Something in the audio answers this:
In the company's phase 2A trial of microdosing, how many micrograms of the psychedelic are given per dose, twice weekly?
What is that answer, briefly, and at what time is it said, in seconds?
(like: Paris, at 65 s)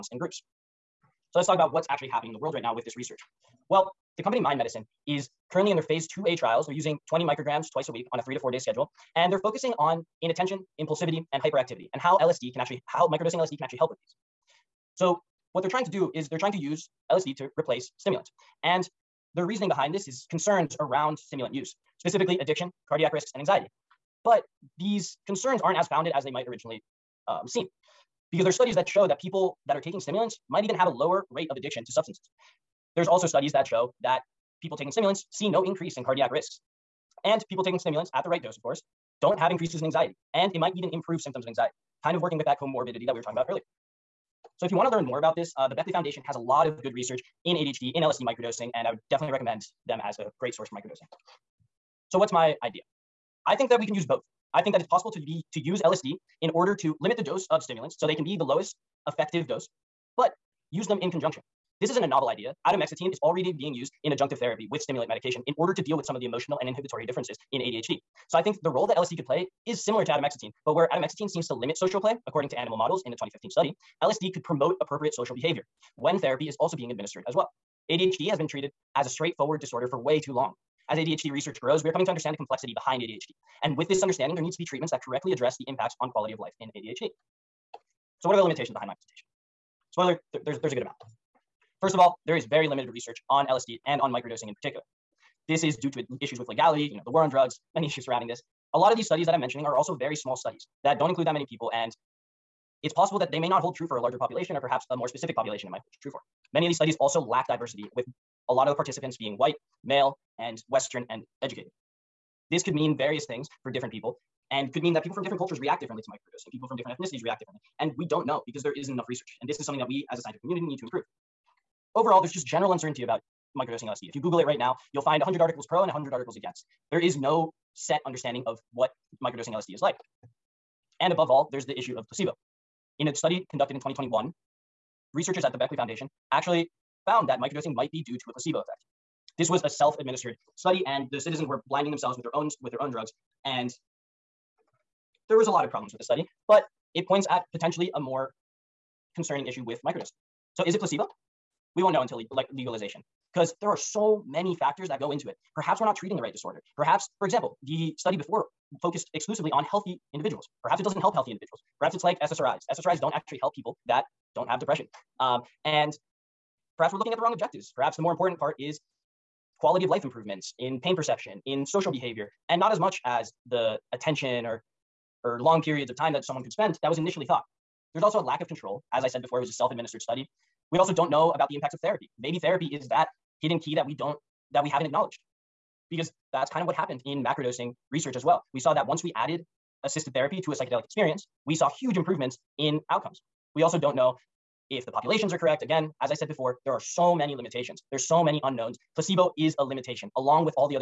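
20, at 7 s.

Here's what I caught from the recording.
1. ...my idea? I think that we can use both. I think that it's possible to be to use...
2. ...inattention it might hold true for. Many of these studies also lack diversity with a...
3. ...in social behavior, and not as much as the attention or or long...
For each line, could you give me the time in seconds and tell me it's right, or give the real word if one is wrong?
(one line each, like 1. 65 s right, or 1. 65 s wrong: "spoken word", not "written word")
1. 52 s right
2. 105 s wrong: "population", not "inattention"
3. 171 s right.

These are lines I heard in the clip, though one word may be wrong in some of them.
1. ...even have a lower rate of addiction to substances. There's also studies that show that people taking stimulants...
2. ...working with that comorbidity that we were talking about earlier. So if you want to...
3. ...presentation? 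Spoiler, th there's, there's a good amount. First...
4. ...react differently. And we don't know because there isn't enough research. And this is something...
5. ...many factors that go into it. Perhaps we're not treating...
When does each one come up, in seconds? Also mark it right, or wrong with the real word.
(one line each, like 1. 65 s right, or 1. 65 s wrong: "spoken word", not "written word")
1. 30 s right
2. 42 s right
3. 88 s right
4. 117 s right
5. 154 s right.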